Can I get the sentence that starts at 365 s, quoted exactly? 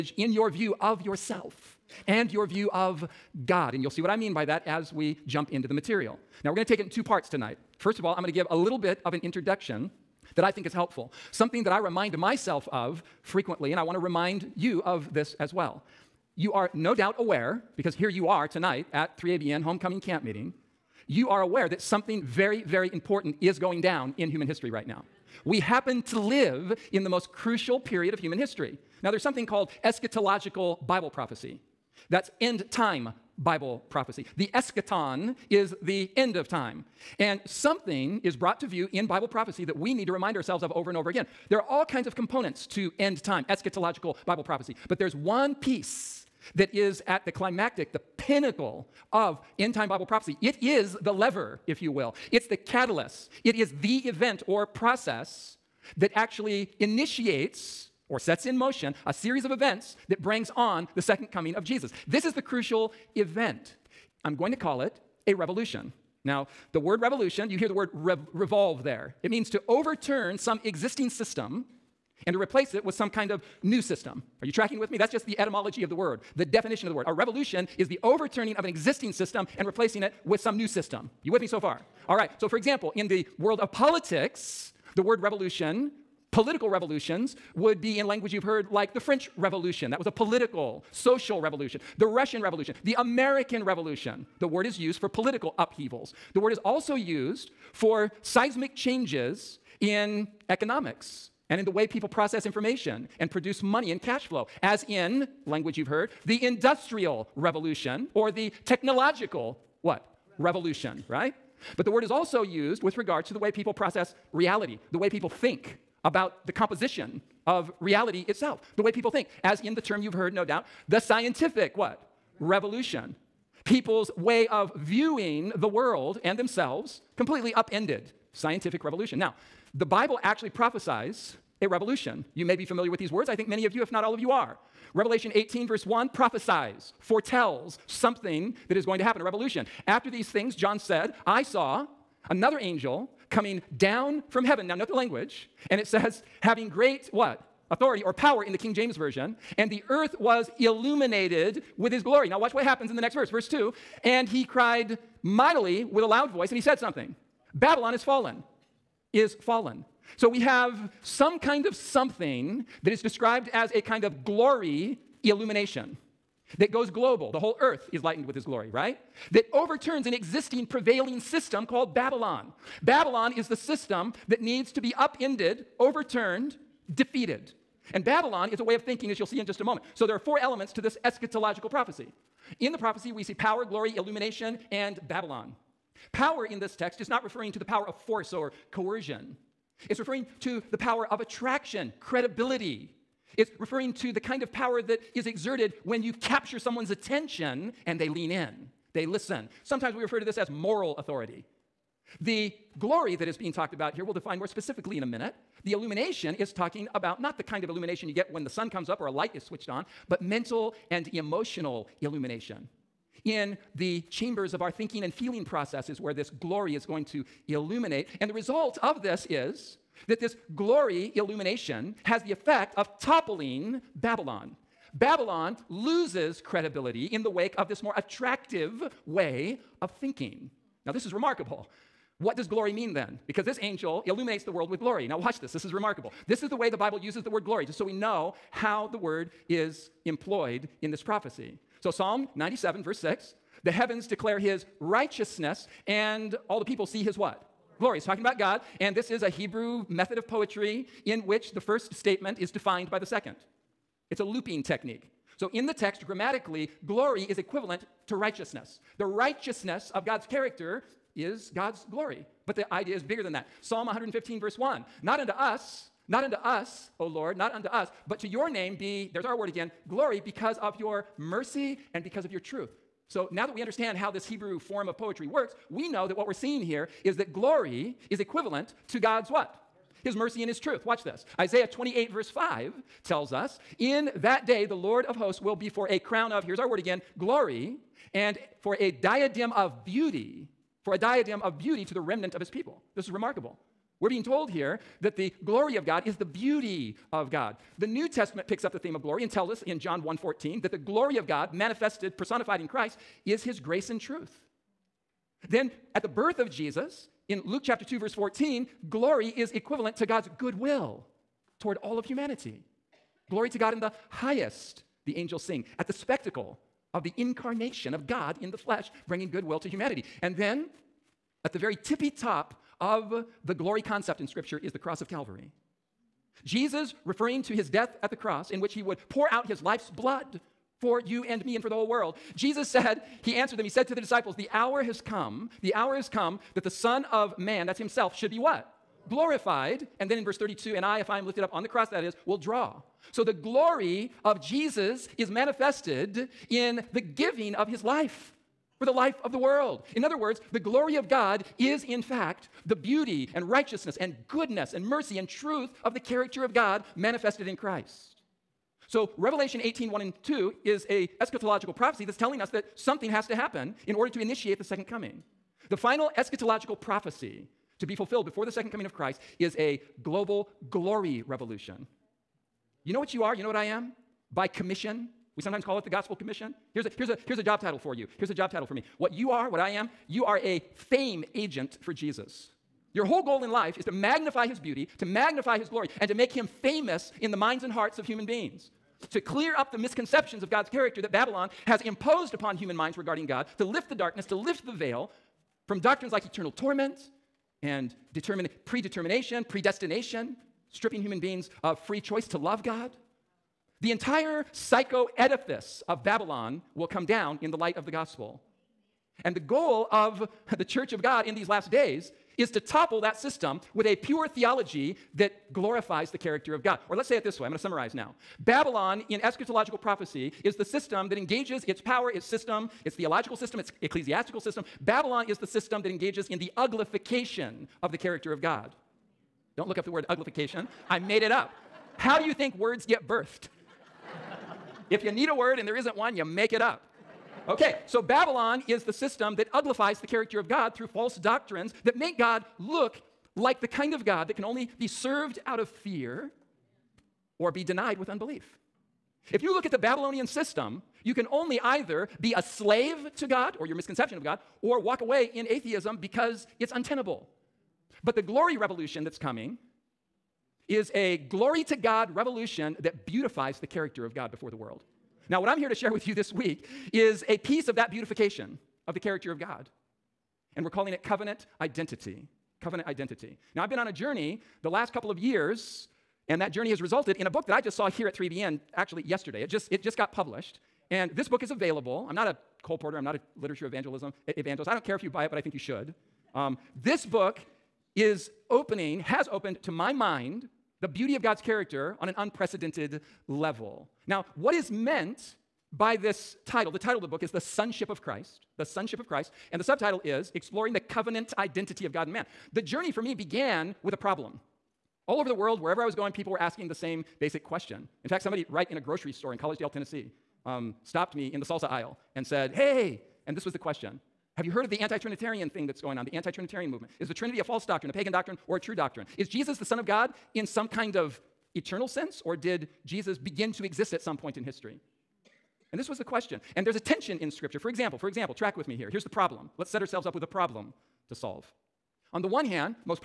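The final eschatological prophecy to be fulfilled before the second coming of Christ is a global glory revolution.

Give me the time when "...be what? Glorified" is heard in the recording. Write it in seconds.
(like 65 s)
338 s.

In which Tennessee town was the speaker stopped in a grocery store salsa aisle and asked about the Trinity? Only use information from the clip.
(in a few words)
Collegedale.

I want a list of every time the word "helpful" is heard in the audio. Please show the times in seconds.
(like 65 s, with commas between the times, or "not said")
10 s.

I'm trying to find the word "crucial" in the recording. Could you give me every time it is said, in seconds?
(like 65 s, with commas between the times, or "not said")
27 s, 62 s.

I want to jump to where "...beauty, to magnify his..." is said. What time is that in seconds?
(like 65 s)
384 s.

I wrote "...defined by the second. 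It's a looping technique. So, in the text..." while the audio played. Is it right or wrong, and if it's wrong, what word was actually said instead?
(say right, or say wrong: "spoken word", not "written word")
right.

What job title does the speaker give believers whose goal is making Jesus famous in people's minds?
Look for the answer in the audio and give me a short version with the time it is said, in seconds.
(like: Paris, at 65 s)
fame agent, at 380 s.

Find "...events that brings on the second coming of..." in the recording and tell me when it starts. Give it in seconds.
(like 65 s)
59 s.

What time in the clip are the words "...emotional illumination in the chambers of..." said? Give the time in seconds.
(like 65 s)
211 s.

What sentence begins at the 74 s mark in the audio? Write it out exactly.
That's just the etymology of the word, the definition of the word.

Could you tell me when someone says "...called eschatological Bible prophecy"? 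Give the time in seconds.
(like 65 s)
29 s.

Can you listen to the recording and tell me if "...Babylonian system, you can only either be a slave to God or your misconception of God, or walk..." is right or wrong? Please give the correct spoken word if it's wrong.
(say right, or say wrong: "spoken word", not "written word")
right.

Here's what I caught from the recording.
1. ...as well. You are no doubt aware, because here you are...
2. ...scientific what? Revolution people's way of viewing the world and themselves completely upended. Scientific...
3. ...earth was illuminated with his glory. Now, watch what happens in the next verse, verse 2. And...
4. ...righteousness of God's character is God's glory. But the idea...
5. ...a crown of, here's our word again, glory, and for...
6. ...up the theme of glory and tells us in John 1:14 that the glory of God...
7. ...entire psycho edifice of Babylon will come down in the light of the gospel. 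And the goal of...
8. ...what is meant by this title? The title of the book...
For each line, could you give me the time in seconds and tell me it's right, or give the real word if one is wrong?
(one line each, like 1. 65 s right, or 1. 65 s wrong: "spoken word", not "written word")
1. 15 s right
2. 120 s right
3. 149 s right
4. 259 s right
5. 285 s right
6. 298 s right
7. 403 s right
8. 494 s right.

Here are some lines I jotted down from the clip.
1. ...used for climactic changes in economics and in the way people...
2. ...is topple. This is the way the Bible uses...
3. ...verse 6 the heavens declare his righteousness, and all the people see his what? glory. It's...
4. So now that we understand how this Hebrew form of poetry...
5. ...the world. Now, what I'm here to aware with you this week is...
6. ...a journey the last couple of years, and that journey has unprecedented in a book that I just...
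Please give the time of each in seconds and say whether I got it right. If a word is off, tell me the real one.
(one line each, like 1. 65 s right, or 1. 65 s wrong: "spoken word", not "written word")
1. 96 s wrong: "seismic", not "climactic"
2. 235 s wrong: "remarkable", not "topple"
3. 242 s right
4. 273 s right
5. 464 s wrong: "share", not "aware"
6. 473 s wrong: "resulted", not "unprecedented".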